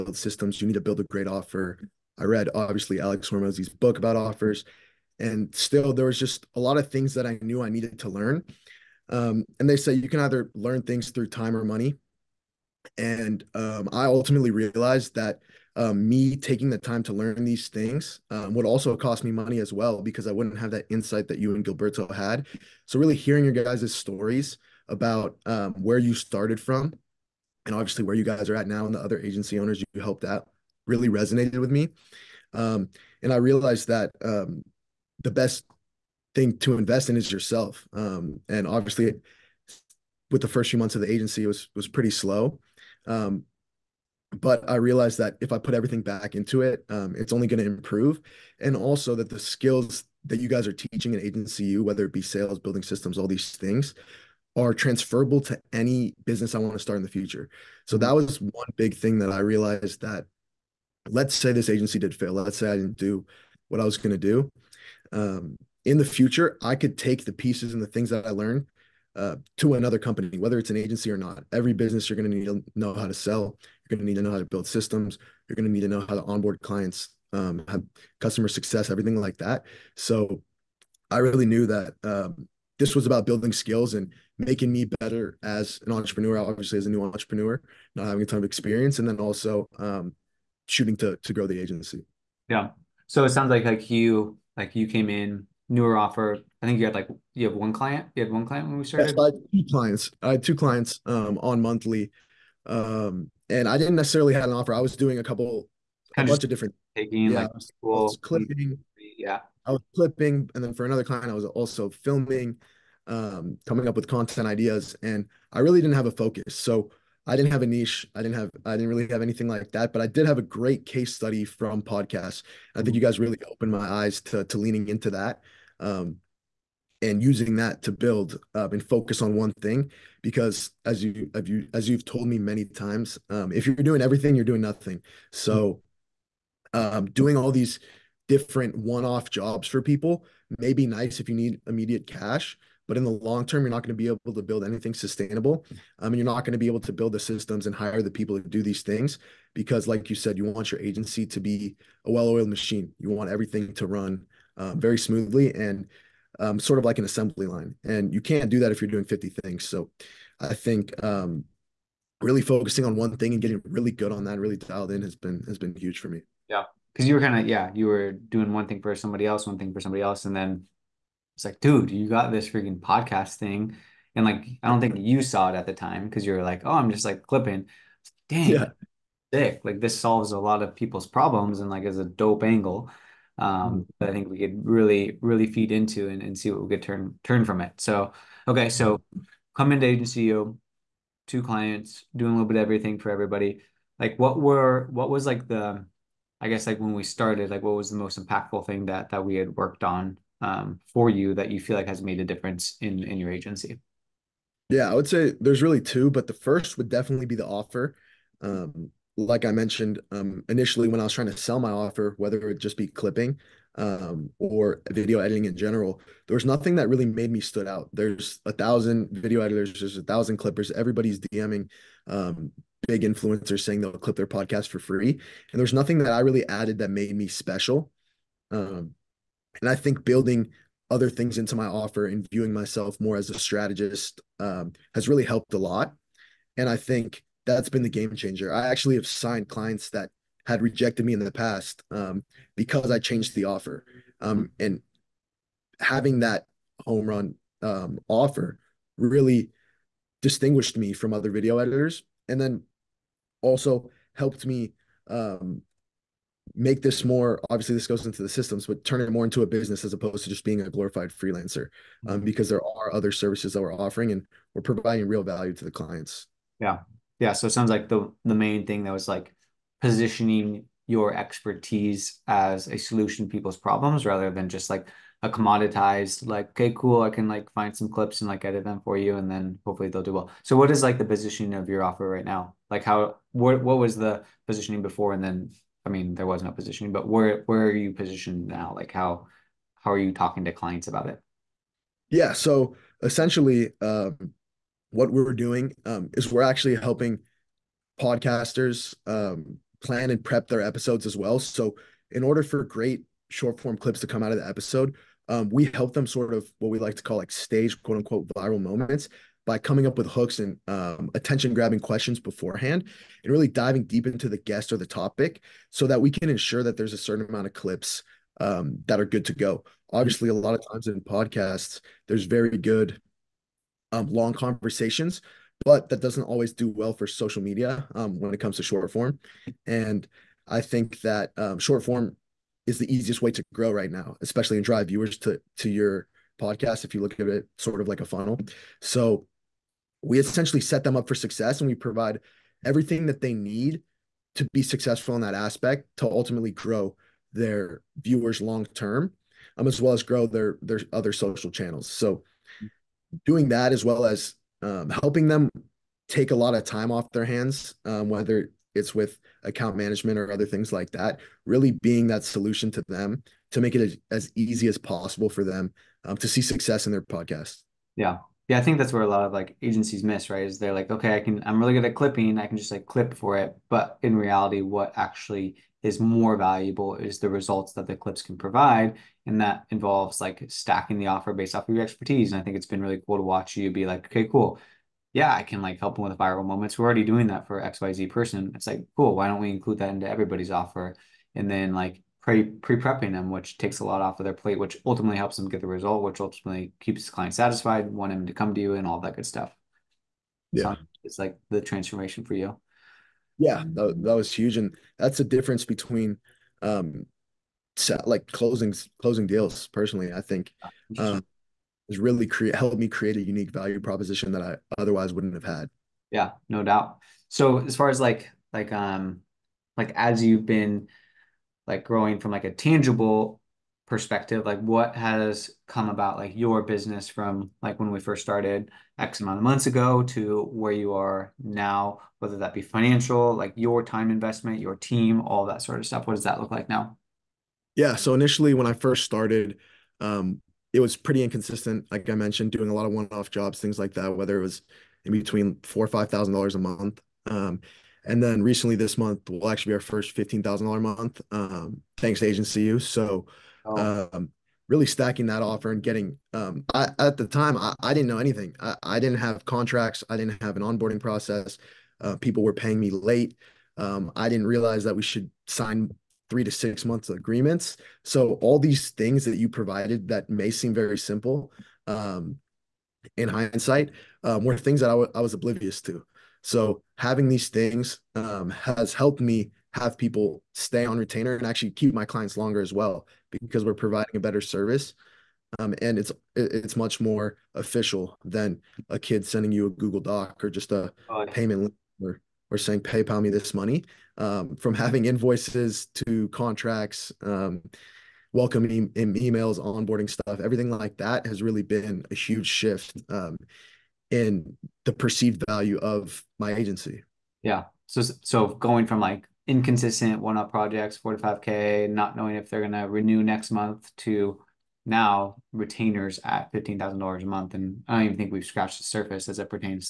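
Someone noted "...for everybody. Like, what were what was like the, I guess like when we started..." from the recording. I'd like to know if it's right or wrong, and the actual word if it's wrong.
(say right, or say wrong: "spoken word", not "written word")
right.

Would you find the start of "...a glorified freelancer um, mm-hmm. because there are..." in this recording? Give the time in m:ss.
4:20.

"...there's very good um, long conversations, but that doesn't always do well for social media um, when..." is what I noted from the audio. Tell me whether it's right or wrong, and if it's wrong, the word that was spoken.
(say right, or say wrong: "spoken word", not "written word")
right.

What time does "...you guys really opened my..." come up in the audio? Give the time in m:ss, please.
2:02.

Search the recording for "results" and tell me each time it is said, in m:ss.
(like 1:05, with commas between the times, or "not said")
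6:17, 6:35.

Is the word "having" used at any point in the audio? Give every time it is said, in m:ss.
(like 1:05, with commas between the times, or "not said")
1:28, 4:05, 7:56, 8:14.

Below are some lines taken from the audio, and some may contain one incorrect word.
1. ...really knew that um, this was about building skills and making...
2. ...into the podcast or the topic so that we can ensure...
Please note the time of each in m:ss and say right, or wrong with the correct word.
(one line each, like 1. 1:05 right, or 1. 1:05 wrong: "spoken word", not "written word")
1. 1:21 right
2. 5:14 wrong: "guest", not "podcast".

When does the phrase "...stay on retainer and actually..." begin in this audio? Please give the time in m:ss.
8:00.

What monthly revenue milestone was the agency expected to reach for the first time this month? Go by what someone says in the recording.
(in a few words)
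$15,000.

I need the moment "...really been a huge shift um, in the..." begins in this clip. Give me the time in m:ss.
8:21.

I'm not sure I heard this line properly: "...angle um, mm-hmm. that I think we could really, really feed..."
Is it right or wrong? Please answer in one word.
right.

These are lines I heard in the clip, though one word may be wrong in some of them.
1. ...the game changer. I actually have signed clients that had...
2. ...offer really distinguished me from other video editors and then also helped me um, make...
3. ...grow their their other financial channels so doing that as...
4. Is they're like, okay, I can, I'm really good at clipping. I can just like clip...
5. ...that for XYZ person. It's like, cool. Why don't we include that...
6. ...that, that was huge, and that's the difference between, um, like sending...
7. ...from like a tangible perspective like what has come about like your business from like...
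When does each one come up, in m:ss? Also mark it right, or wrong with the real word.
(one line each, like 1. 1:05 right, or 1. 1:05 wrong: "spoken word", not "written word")
1. 3:57 right
2. 4:08 right
3. 5:50 wrong: "social", not "financial"
4. 6:10 right
5. 6:27 right
6. 6:43 wrong: "closing", not "sending"
7. 7:02 right.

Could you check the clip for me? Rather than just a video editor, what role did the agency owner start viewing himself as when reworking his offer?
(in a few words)
strategist.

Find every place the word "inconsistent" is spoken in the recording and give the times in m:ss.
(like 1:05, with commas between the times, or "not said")
7:21, 8:29.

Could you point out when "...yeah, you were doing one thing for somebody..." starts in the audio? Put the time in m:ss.
2:47.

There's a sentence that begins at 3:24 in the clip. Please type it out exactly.
Yeah, I would say there's really two, but the first would definitely be the offer.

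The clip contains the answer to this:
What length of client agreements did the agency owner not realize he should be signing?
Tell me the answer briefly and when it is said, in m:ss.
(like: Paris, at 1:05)
3 to 6 months, at 7:46.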